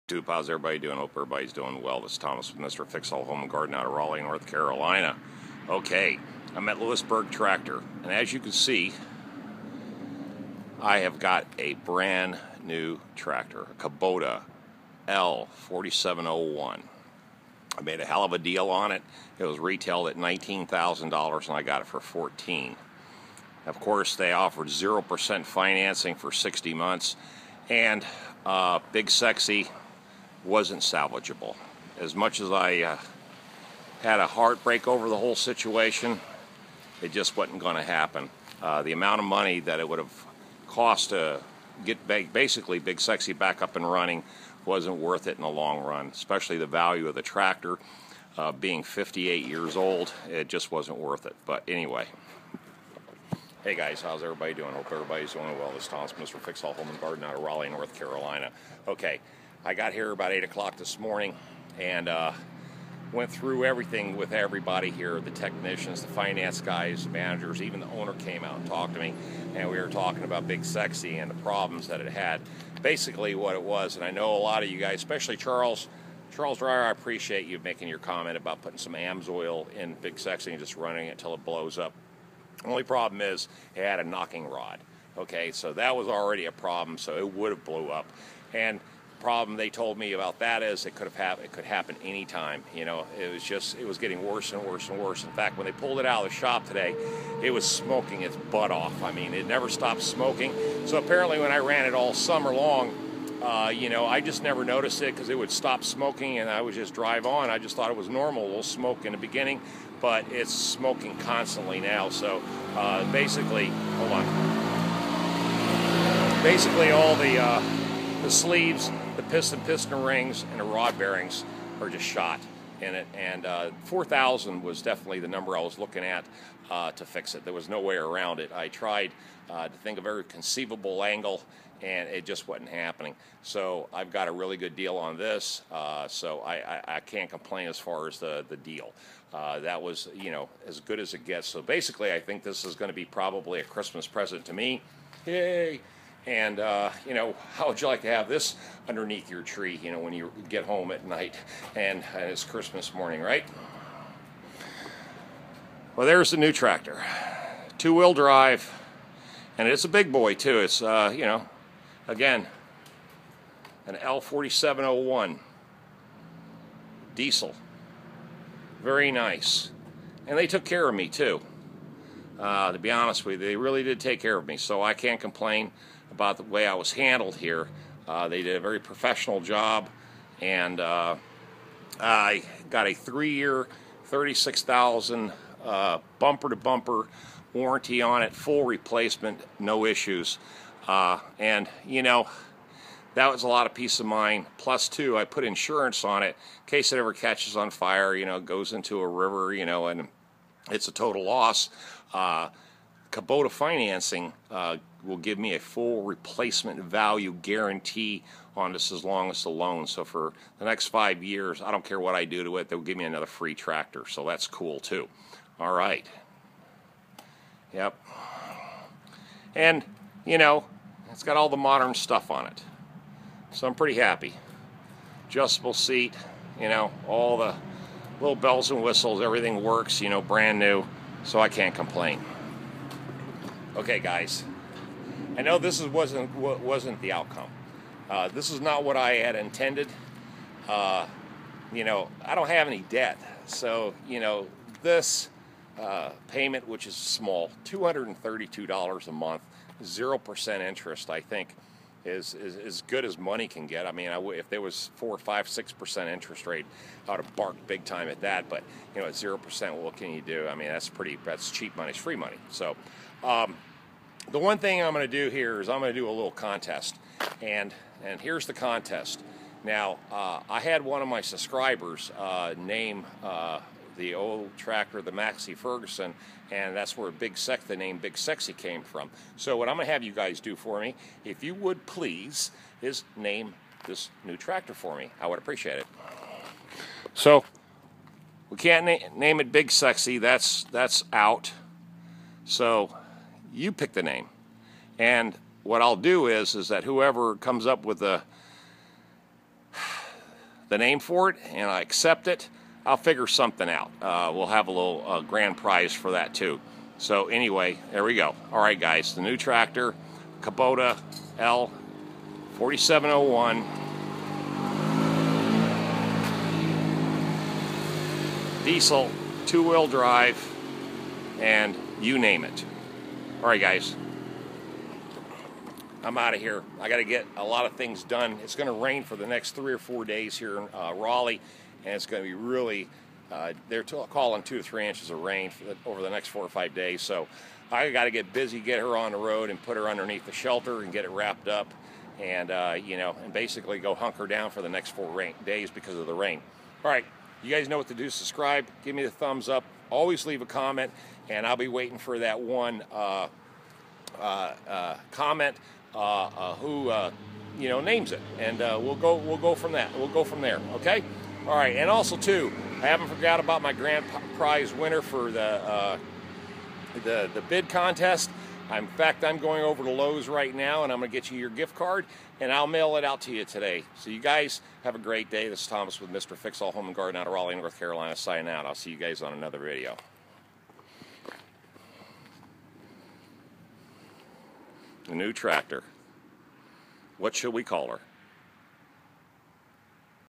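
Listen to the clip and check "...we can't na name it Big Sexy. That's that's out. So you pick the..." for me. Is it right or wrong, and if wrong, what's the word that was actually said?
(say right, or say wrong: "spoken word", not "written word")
right.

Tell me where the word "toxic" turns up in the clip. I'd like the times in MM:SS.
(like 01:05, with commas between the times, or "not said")
not said.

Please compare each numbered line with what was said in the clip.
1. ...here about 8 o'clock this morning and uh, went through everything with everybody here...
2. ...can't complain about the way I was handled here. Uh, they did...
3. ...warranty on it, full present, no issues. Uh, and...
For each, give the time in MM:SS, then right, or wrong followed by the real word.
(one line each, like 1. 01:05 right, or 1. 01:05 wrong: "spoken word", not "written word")
1. 00:59 right
2. 02:54 right
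3. 03:07 wrong: "replacement", not "present".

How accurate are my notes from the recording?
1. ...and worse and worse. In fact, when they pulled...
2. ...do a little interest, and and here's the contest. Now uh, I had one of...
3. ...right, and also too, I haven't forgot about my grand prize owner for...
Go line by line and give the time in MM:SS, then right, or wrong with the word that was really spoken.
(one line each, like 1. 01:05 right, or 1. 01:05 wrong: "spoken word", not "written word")
1. 01:34 right
2. 04:25 wrong: "contest", not "interest"
3. 06:01 wrong: "winner", not "owner".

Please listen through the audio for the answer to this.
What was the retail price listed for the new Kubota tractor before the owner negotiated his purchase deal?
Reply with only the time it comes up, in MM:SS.
00:20.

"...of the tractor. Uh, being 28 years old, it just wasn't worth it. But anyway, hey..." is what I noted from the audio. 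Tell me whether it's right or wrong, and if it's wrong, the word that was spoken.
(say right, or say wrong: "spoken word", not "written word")
wrong: "58", not "28".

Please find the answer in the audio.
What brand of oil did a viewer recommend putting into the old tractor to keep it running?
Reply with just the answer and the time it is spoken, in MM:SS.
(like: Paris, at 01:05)
AMSOIL, at 01:18.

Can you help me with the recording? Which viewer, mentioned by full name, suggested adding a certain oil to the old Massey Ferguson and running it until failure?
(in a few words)
Charles Dreyer.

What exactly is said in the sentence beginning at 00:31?
As much as I uh, had a heartbreak over the whole situation, it just wasn't going to happen.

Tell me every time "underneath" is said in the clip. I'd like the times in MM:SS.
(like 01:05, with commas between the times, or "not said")
02:28, 05:39.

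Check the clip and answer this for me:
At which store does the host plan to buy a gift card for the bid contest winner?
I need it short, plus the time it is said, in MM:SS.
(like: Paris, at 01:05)
Lowe's, at 06:09.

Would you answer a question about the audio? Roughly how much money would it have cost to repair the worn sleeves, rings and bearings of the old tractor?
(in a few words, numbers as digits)
4,000.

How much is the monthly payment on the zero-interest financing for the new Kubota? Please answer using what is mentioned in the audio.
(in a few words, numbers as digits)
$232.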